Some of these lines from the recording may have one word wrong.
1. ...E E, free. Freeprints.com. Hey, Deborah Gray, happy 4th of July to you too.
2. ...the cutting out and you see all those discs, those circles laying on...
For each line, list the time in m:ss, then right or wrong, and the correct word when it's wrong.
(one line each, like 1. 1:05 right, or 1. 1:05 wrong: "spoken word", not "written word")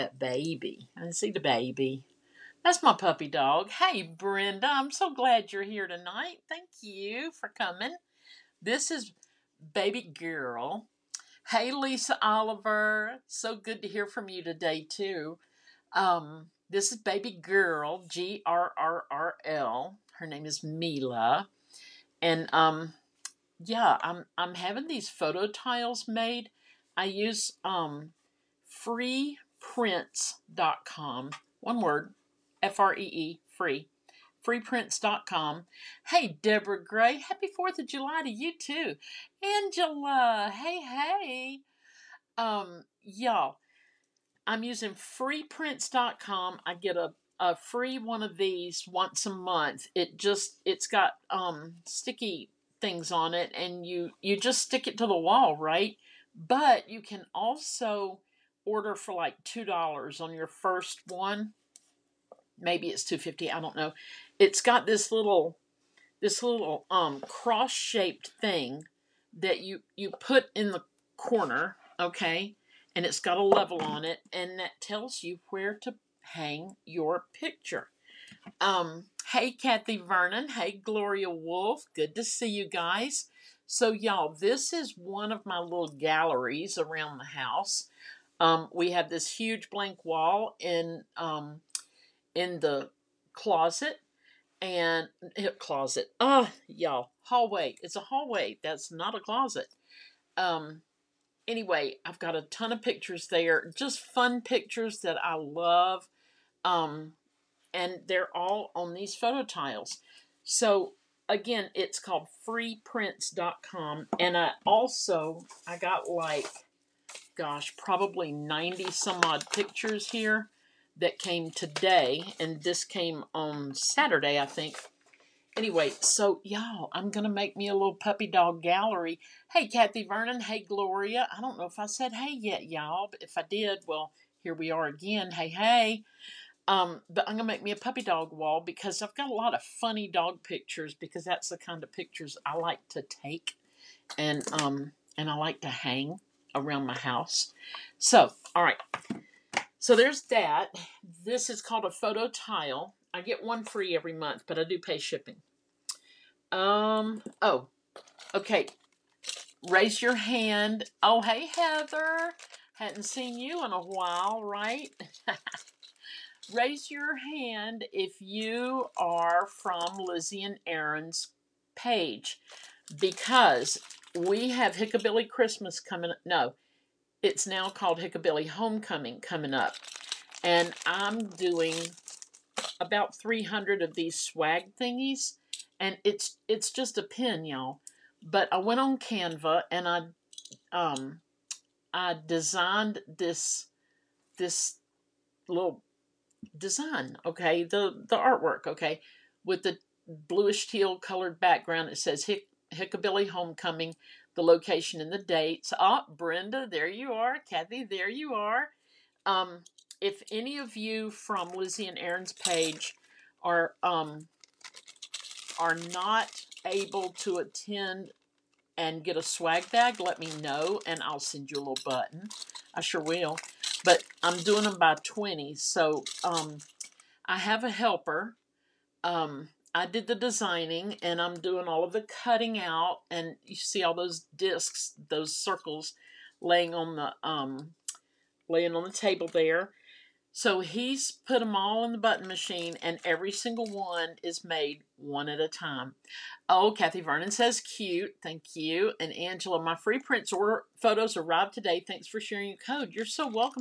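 1. 0:32 right
2. 3:51 right.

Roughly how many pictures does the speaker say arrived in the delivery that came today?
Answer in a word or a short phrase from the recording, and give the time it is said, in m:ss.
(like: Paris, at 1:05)
90, at 1:58.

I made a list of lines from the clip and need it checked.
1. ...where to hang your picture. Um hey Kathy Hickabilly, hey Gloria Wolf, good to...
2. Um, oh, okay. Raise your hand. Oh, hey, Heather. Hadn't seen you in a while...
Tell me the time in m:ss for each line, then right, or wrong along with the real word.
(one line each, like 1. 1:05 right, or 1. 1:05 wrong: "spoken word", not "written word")
1. 1:15 wrong: "Vernon", not "Hickabilly"
2. 2:36 right.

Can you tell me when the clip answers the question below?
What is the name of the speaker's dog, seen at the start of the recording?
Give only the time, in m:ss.
0:20.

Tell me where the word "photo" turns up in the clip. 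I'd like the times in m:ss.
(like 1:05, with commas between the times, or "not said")
0:25, 1:49, 2:31, 4:10.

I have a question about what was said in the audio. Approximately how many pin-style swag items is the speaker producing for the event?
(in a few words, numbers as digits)
300.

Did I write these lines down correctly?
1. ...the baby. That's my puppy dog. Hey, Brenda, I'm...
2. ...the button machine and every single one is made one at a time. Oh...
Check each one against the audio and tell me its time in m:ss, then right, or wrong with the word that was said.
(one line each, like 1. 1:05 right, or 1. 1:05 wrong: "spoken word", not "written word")
1. 0:01 right
2. 4:01 right.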